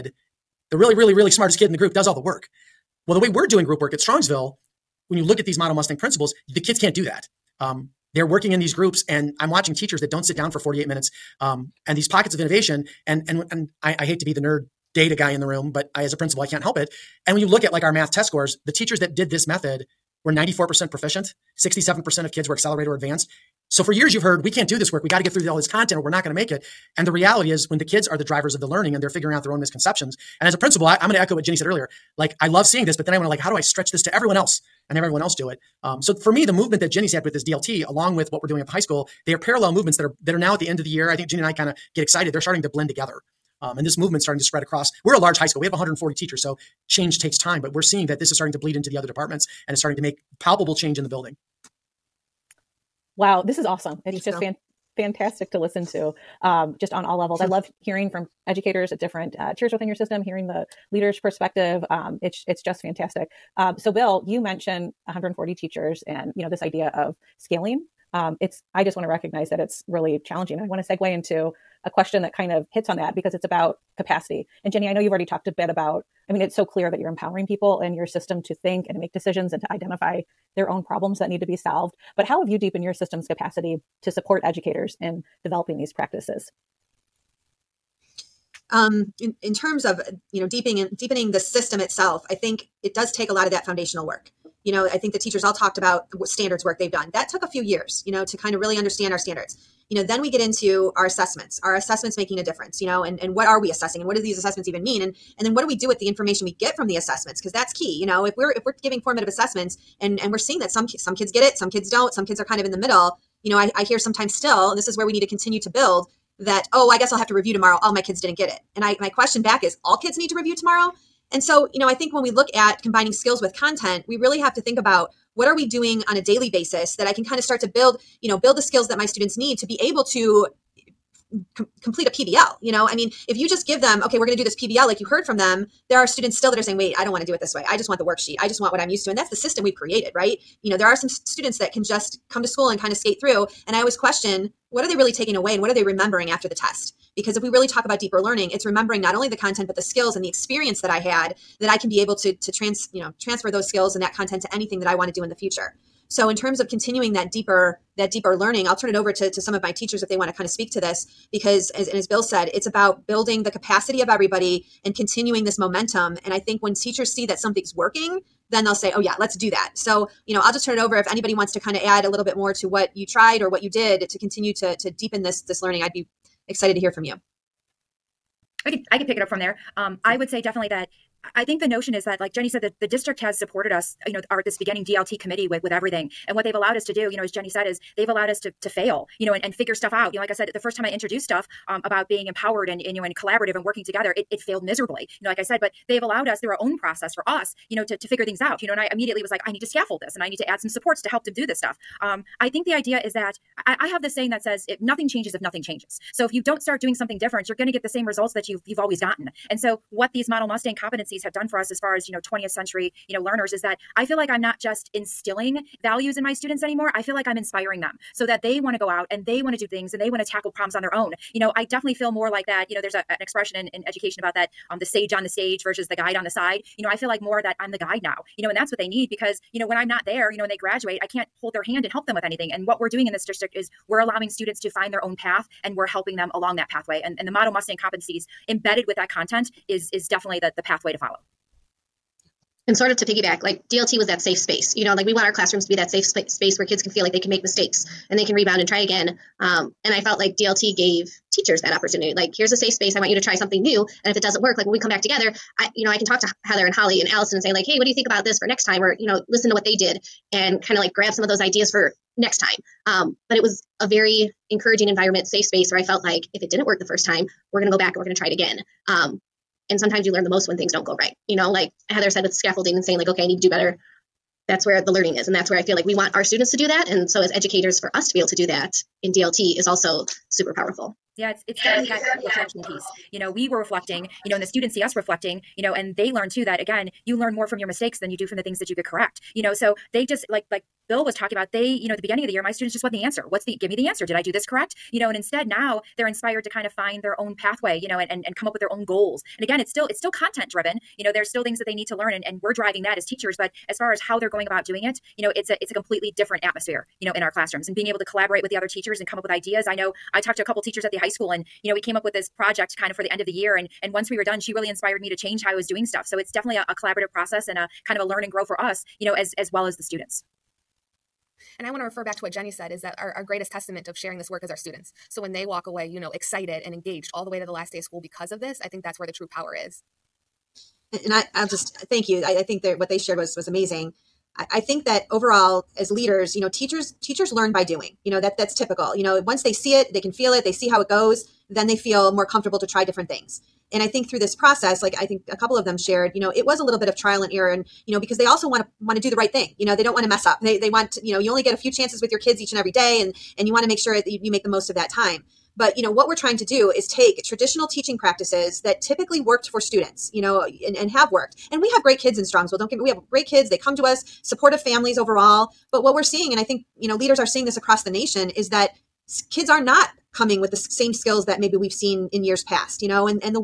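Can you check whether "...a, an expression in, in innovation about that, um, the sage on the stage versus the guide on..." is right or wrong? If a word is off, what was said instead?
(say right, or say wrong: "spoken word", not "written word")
wrong: "education", not "innovation".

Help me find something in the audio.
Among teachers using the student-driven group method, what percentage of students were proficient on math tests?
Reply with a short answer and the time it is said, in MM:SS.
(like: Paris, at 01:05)
94%, at 00:20.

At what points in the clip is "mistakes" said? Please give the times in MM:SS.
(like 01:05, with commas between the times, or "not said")
04:07, 04:47.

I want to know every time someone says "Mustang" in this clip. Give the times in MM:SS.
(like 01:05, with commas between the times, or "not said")
00:05, 03:30, 03:57.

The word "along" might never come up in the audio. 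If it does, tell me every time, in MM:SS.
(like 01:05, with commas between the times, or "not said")
00:37, 03:56.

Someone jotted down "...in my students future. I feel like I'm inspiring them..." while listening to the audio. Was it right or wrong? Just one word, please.
wrong.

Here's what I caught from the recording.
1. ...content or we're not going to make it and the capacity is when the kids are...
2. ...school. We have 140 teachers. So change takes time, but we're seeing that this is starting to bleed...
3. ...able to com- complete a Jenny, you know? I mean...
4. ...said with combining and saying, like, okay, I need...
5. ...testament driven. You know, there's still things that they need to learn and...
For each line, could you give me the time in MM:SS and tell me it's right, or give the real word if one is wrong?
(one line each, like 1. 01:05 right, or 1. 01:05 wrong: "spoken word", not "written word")
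1. 00:25 wrong: "reality", not "capacity"
2. 00:45 right
3. 02:09 wrong: "PBL", not "Jenny"
4. 04:32 wrong: "scaffolding", not "combining"
5. 05:00 wrong: "content", not "testament".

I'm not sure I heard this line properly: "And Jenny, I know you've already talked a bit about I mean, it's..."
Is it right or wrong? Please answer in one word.
right.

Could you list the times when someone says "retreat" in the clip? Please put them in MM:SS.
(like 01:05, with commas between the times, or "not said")
not said.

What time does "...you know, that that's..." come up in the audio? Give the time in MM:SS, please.
05:38.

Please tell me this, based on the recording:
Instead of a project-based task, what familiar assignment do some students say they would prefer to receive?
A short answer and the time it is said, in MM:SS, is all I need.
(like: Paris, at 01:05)
the worksheet, at 02:17.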